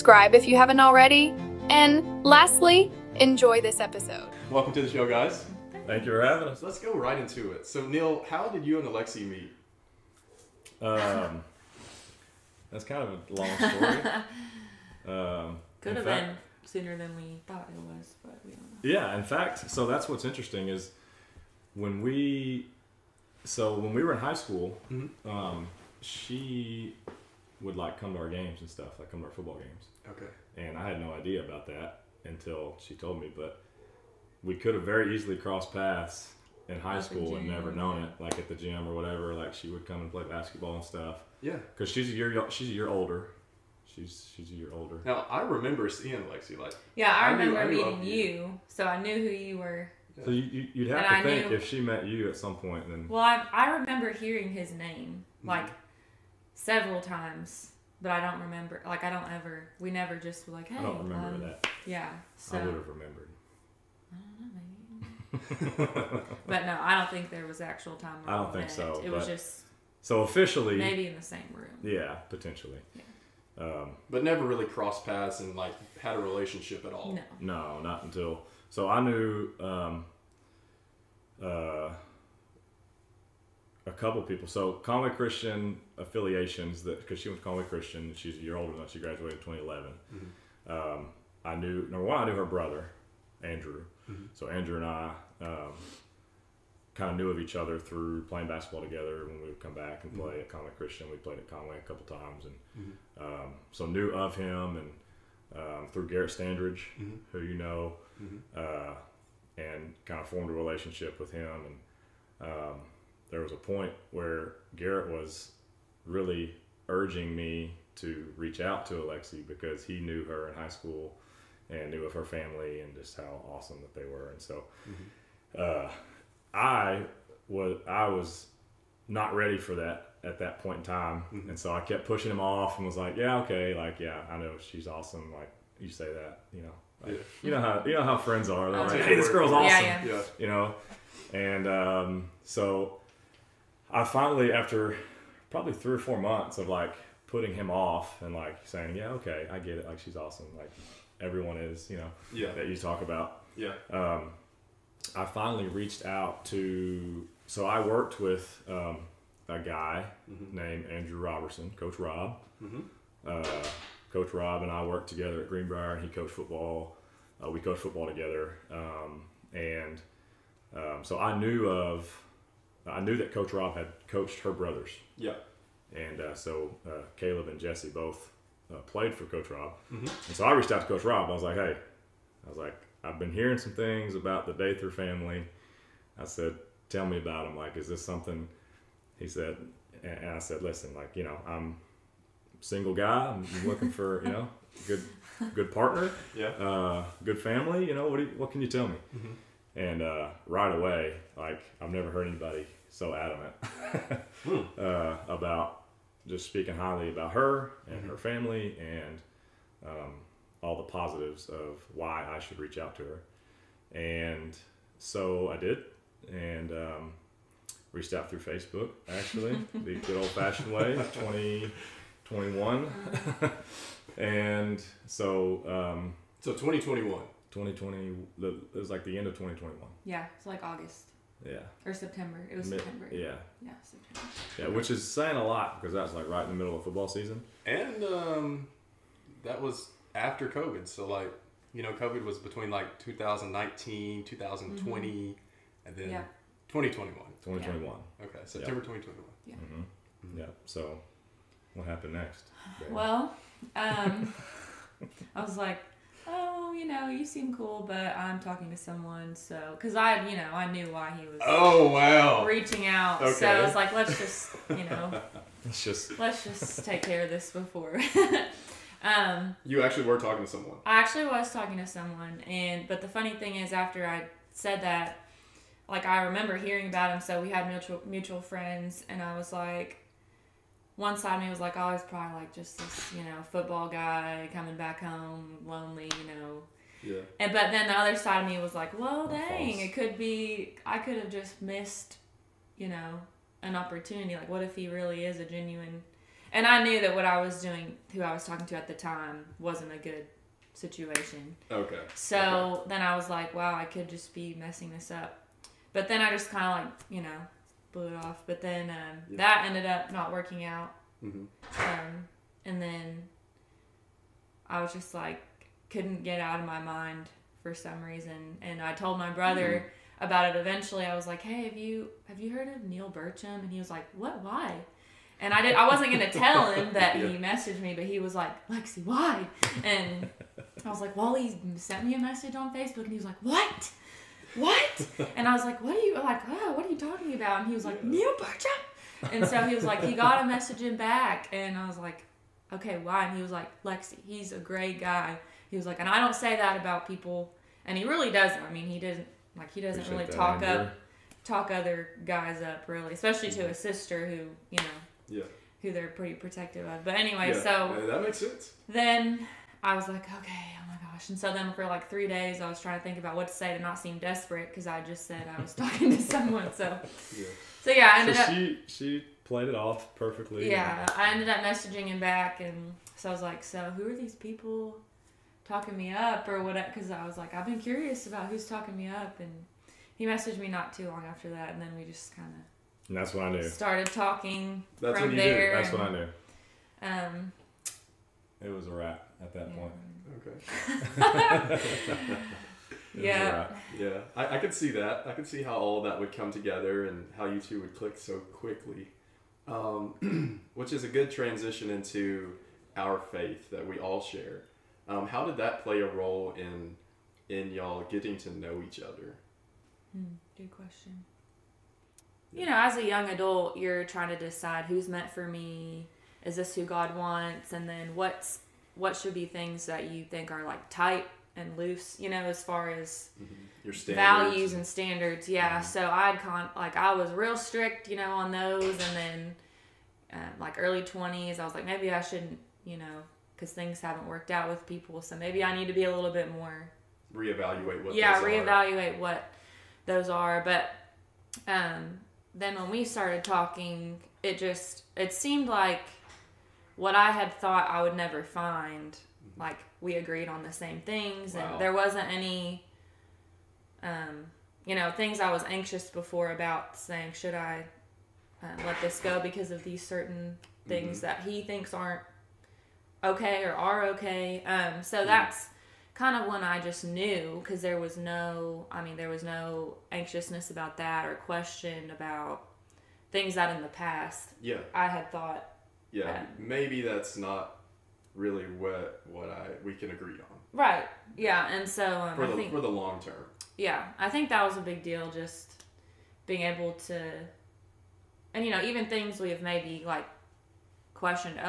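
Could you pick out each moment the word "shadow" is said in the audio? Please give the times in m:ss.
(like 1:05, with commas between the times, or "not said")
not said.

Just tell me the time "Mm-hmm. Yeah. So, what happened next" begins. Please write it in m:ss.
4:10.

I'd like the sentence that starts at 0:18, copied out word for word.
Yeah, in fact, so that's what's interesting is when we, so when we were in high school, mm-hmm.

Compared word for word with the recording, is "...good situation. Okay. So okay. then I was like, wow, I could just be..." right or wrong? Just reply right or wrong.
right.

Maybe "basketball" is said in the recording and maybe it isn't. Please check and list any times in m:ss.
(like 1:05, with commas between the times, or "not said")
0:40, 1:38.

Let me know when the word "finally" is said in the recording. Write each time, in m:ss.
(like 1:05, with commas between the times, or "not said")
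2:24, 2:35.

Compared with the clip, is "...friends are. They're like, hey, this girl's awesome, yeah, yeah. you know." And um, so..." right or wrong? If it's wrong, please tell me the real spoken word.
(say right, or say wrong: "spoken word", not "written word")
right.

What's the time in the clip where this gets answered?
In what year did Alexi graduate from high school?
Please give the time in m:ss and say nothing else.
1:29.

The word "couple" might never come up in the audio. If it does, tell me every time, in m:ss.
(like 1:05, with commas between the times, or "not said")
1:23, 1:41.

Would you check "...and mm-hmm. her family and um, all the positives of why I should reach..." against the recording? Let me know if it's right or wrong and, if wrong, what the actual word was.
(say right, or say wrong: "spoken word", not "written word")
right.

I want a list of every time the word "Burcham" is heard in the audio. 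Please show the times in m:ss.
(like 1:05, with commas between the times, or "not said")
5:23, 5:38.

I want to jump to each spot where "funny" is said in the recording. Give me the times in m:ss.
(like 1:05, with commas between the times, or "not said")
4:33.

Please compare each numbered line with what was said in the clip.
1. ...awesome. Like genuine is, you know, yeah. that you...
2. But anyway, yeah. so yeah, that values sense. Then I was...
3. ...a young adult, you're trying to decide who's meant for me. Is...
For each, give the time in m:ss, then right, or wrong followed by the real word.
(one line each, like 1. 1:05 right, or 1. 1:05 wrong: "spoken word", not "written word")
1. 2:30 wrong: "everyone", not "genuine"
2. 5:57 wrong: "makes", not "values"
3. 6:52 right.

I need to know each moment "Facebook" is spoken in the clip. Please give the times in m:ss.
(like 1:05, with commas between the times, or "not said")
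3:38, 5:32.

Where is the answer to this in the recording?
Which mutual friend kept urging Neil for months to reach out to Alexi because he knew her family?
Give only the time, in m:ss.
1:46.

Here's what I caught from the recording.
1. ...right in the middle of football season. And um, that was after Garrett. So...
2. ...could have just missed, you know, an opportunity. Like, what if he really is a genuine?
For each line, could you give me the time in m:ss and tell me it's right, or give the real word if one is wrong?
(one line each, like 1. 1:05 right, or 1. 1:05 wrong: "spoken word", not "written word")
1. 3:56 wrong: "COVID", not "Garrett"
2. 4:50 right.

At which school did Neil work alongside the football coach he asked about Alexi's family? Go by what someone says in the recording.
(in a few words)
Greenbrier.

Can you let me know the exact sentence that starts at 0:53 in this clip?
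Well, I, I remember hearing his name mm-hmm.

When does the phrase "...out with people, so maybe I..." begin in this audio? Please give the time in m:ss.
7:14.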